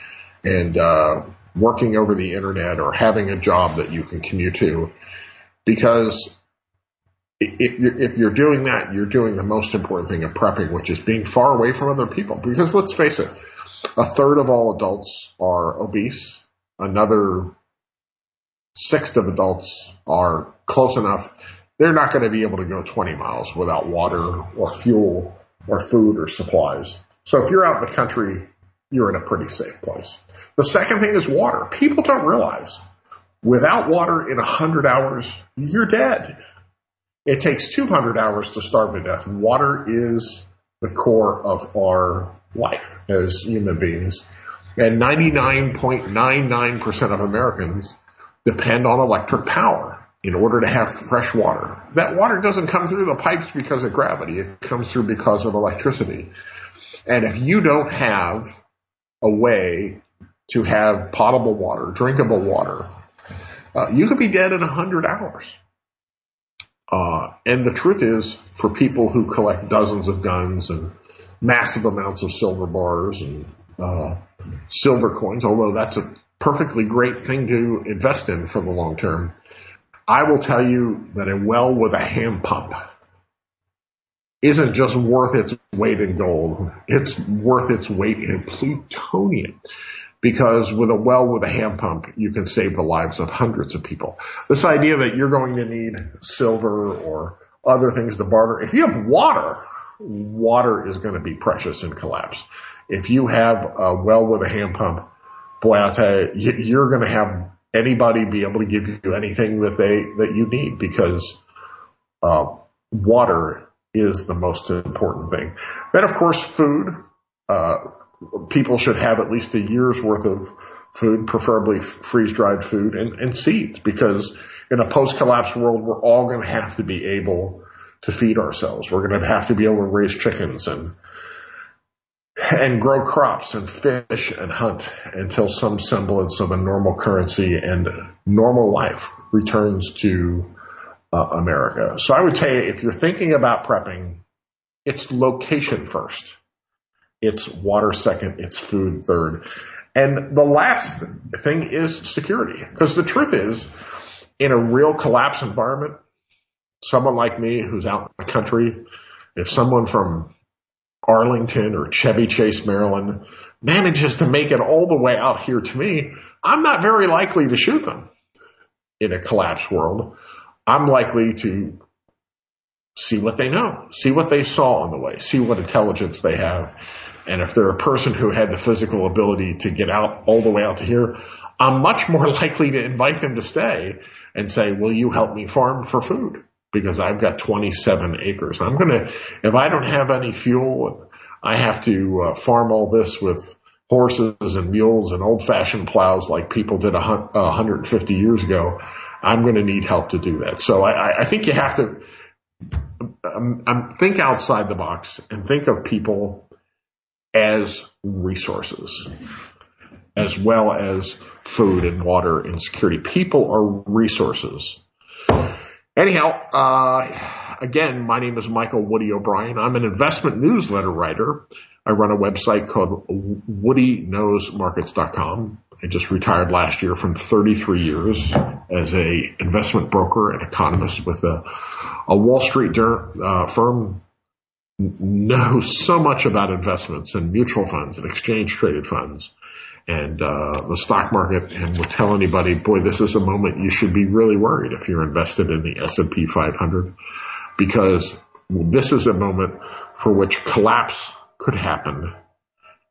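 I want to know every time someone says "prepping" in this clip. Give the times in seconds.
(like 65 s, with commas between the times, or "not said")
10 s, 143 s.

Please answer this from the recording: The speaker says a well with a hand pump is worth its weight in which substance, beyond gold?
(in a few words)
plutonium.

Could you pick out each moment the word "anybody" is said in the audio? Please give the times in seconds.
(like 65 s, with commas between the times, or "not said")
107 s, 242 s.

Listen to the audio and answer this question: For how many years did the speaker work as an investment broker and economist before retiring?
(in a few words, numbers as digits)
33.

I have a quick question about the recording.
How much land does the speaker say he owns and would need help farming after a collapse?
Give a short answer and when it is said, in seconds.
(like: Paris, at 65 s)
27 acres, at 187 s.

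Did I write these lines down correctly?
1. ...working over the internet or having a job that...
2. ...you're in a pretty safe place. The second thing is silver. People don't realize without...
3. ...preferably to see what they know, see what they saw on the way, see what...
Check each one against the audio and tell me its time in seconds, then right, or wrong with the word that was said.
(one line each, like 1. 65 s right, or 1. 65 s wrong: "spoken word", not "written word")
1. 1 s right
2. 28 s wrong: "water", not "silver"
3. 170 s wrong: "likely", not "preferably".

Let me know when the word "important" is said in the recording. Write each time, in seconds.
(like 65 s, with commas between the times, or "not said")
9 s, 114 s.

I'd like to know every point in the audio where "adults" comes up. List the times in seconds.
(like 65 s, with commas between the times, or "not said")
14 s, 19 s.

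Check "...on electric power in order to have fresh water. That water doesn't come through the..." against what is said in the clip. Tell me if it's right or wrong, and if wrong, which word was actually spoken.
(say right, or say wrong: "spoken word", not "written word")
right.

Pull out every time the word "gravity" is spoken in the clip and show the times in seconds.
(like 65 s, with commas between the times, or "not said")
53 s.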